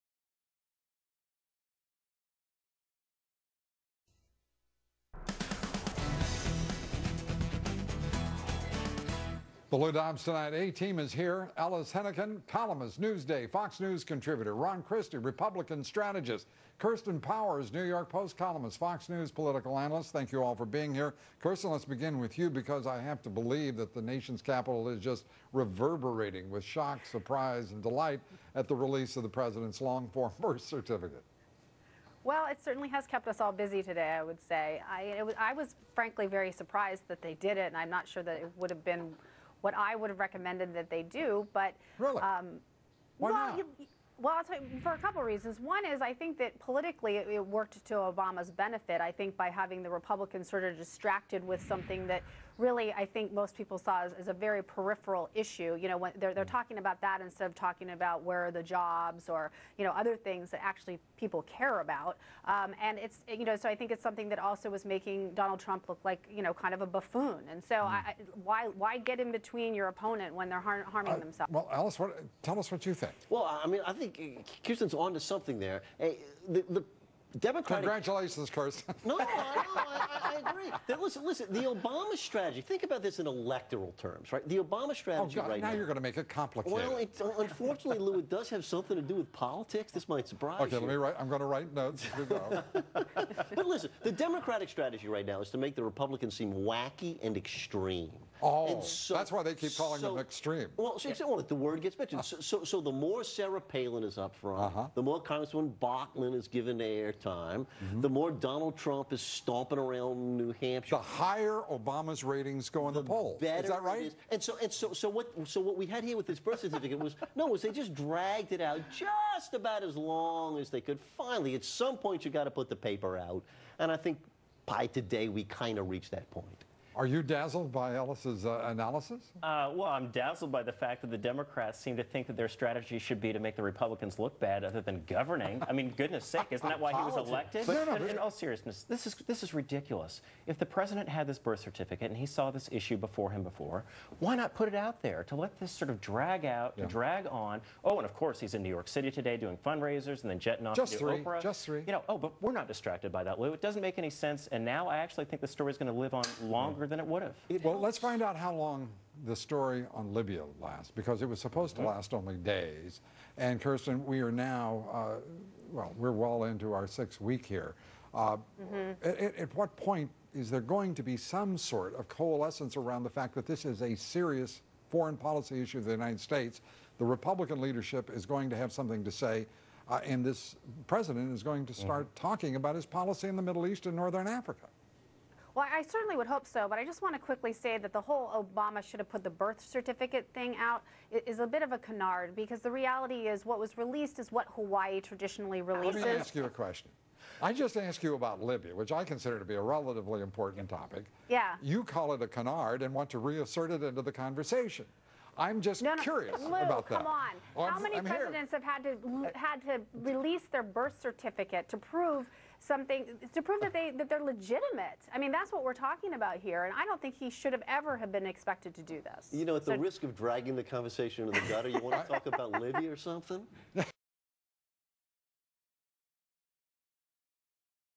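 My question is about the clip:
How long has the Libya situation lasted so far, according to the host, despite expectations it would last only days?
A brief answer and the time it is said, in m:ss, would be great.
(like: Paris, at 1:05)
6 weeks, at 2:46.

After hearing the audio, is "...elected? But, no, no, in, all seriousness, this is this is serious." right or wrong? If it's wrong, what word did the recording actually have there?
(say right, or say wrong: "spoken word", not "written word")
wrong: "ridiculous", not "serious".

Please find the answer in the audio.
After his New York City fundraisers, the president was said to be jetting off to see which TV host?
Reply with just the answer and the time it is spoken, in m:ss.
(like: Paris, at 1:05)
Oprah, at 2:31.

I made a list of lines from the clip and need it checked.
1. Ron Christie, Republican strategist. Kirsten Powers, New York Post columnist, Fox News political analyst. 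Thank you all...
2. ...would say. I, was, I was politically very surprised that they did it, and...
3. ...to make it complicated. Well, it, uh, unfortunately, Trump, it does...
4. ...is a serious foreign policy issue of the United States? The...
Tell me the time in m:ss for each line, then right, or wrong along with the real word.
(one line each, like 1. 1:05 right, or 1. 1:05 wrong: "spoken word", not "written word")
1. 0:14 right
2. 0:34 wrong: "frankly", not "politically"
3. 1:25 wrong: "Lou", not "Trump"
4. 2:53 right.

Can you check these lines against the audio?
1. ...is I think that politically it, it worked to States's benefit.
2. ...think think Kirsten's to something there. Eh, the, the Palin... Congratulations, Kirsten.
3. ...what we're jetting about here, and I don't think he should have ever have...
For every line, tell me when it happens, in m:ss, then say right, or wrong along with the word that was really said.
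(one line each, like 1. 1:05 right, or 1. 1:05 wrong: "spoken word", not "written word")
1. 0:45 wrong: "Obama", not "States"
2. 1:13 wrong: "Democratic", not "Palin"
3. 3:35 wrong: "talking", not "jetting".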